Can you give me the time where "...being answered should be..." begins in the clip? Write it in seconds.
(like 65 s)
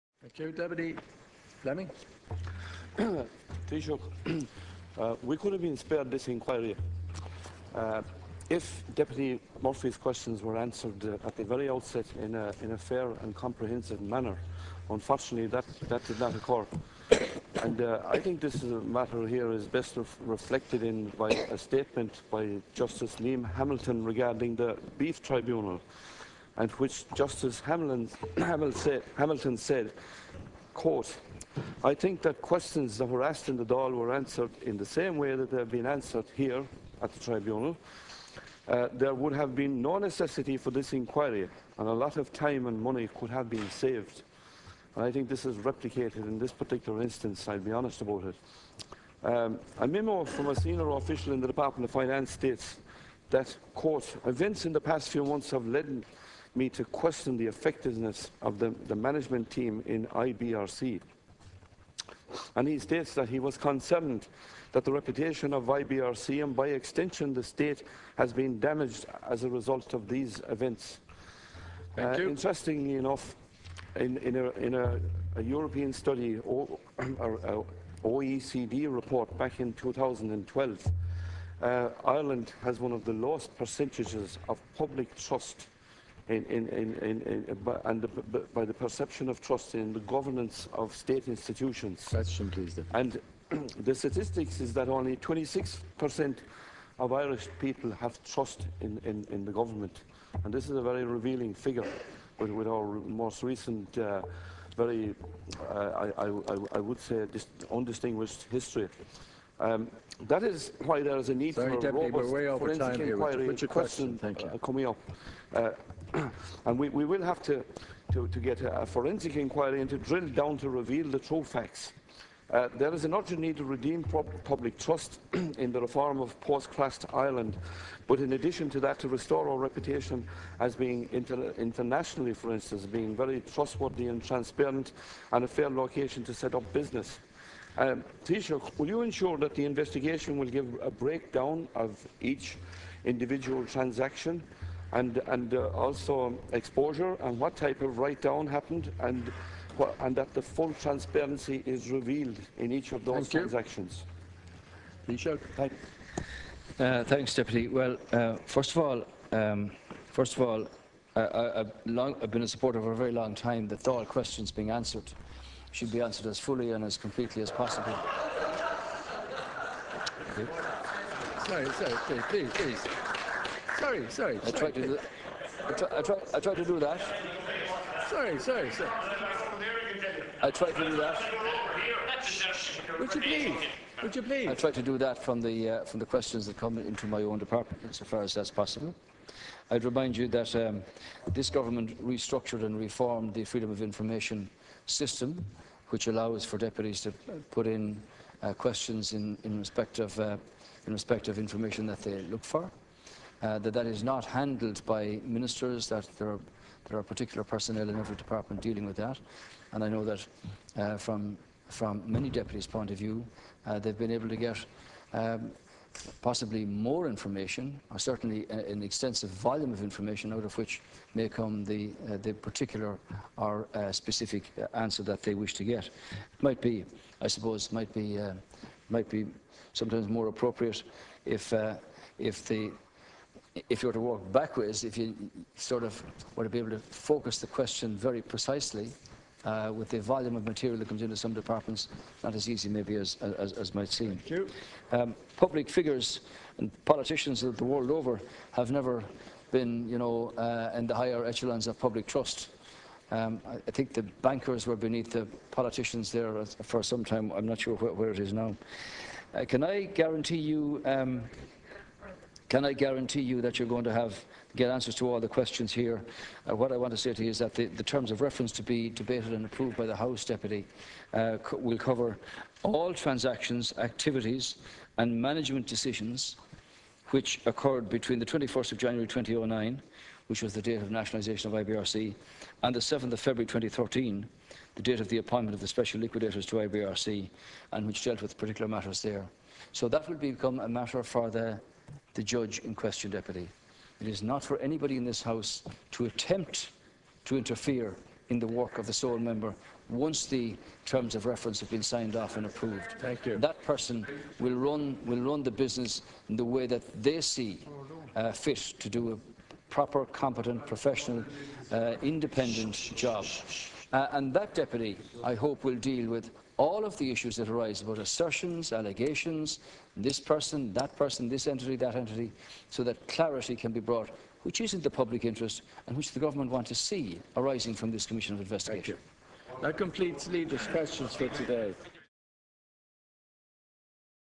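164 s.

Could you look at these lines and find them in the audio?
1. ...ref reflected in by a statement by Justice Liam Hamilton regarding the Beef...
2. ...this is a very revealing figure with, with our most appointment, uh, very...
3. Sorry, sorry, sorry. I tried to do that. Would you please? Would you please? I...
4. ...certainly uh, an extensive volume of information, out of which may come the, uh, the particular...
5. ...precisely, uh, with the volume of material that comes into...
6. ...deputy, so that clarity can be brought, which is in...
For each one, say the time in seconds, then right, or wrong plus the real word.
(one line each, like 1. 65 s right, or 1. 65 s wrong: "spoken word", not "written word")
1. 19 s right
2. 100 s wrong: "recent", not "appointment"
3. 178 s right
4. 217 s right
5. 238 s right
6. 321 s wrong: "entity", not "deputy".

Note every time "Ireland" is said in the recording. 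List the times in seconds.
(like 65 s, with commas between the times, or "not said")
82 s, 127 s.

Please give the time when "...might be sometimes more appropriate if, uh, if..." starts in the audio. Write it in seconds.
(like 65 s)
228 s.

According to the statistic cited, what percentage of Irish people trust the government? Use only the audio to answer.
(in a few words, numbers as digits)
26%.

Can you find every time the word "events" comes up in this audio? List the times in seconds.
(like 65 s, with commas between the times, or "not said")
54 s, 70 s.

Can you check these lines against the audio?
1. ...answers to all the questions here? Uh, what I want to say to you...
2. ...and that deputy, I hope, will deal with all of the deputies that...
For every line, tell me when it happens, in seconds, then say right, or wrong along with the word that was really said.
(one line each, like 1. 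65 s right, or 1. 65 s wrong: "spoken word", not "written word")
1. 264 s right
2. 314 s wrong: "issues", not "deputies".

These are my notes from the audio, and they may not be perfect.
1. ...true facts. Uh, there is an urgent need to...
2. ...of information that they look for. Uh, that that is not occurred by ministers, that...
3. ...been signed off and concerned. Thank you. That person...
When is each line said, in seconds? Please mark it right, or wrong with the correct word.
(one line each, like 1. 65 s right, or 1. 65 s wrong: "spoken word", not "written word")
1. 121 s right
2. 201 s wrong: "handled", not "occurred"
3. 301 s wrong: "approved", not "concerned".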